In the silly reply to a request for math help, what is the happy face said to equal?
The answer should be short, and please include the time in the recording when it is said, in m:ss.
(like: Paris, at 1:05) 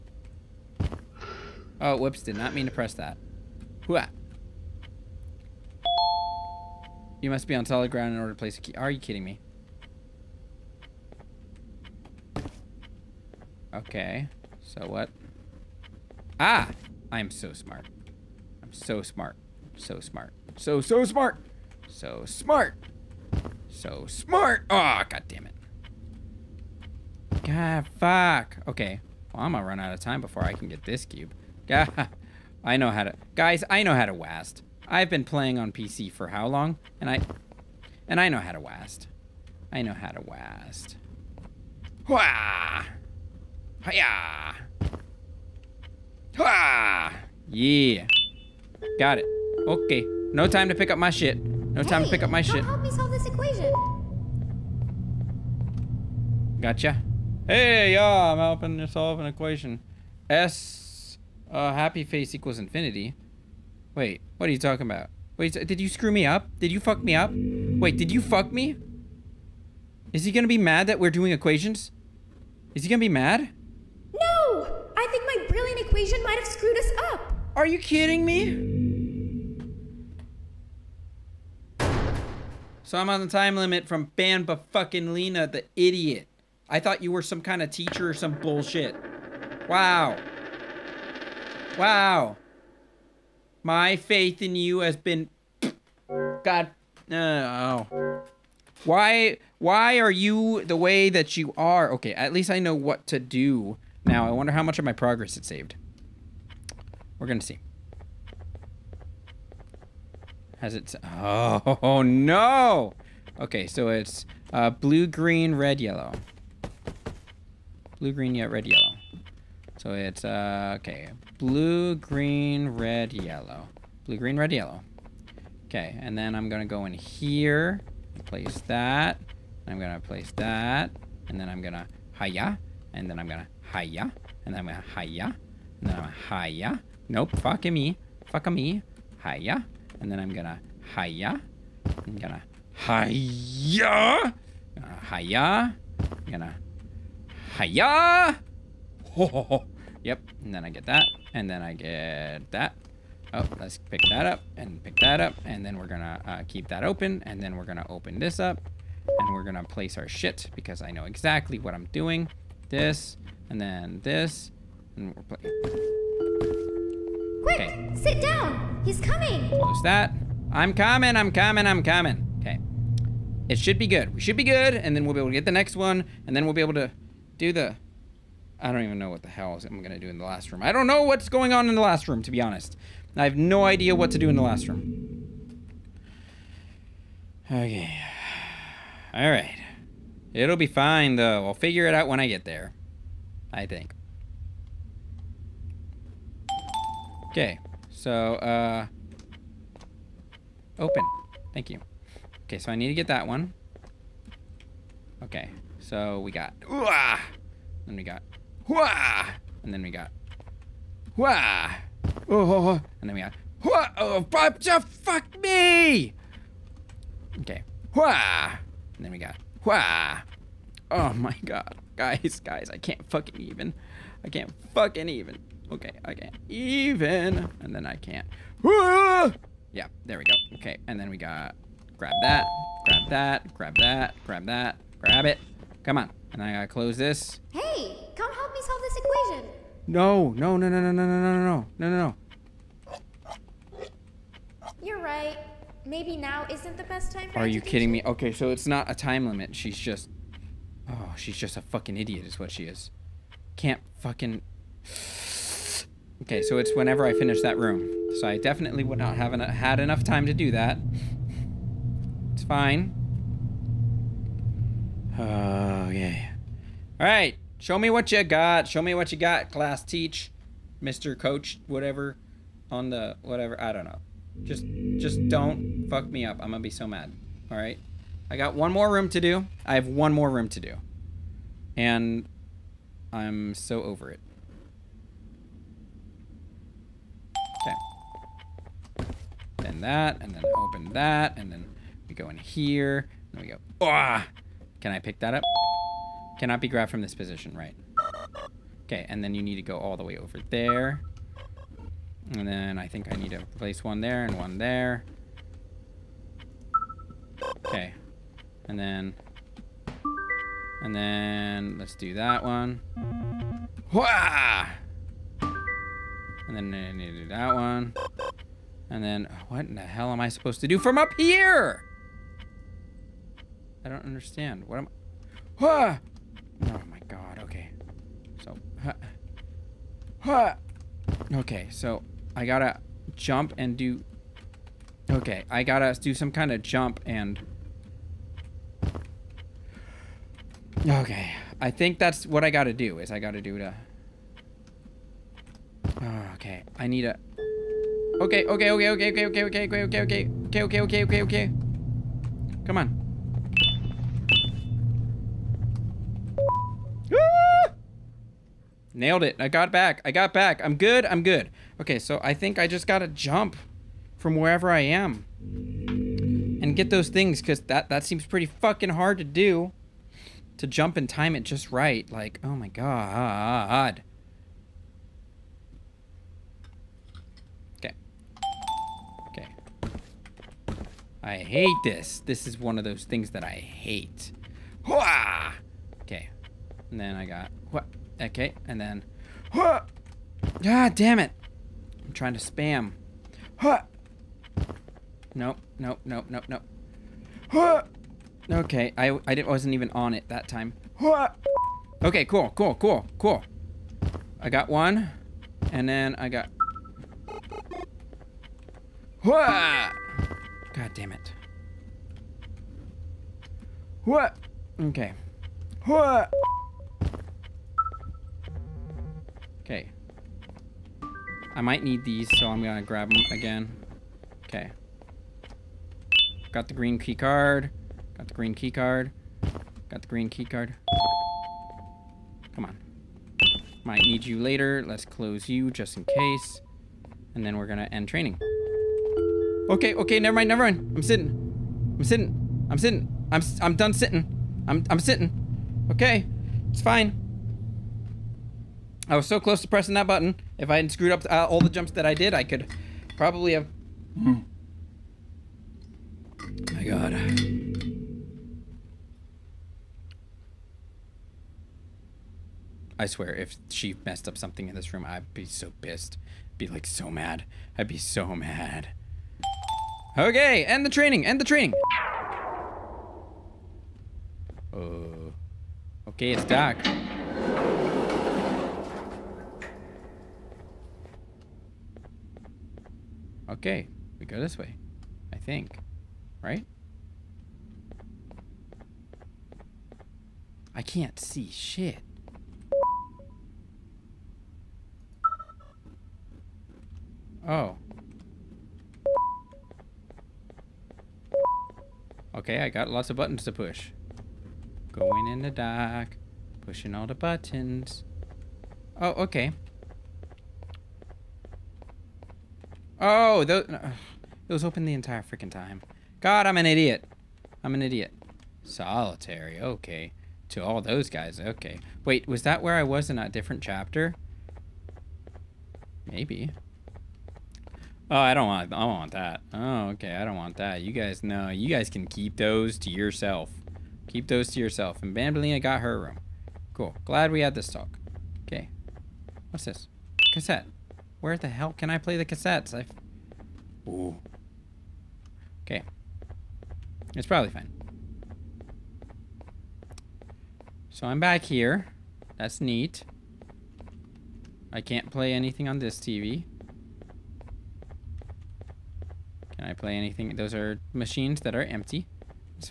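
infinity, at 1:02.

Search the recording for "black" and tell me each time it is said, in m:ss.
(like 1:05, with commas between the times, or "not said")
not said.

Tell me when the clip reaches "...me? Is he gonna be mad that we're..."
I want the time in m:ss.
1:08.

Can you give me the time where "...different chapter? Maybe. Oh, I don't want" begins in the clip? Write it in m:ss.
8:43.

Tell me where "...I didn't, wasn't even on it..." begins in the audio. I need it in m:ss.
6:39.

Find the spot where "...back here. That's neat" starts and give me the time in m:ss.
9:11.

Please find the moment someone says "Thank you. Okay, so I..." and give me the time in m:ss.
3:21.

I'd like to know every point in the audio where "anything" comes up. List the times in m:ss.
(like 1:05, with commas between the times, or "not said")
9:15, 9:19.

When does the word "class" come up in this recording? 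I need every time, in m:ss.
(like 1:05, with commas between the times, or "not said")
4:29.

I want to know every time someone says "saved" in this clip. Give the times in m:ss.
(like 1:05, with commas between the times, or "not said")
1:45.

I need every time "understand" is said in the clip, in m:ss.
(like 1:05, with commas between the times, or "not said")
5:24.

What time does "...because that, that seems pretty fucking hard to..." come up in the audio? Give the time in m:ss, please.
6:07.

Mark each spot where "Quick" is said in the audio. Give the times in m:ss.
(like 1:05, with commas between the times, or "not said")
2:47.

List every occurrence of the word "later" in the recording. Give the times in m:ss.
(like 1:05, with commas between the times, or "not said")
7:14.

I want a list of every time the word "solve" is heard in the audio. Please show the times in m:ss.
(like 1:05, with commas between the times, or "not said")
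0:52, 0:58, 3:58.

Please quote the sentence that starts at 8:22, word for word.
Okay, I got lots of buttons to push.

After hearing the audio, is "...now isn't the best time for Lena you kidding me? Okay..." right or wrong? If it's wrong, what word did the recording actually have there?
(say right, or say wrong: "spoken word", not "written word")
wrong: "Are", not "Lena".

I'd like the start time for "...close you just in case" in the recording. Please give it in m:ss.
7:15.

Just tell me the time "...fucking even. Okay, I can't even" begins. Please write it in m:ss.
3:44.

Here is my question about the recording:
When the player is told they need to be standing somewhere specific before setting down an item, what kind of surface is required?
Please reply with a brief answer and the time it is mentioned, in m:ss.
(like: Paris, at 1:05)
solid ground, at 0:07.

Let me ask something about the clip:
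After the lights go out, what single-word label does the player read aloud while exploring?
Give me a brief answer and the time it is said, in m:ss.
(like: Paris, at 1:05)
Solitary, at 8:38.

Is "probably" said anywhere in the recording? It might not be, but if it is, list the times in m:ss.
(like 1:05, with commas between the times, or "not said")
7:33, 9:07.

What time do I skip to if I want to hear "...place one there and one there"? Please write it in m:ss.
5:03.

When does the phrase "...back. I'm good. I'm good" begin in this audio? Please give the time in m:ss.
6:00.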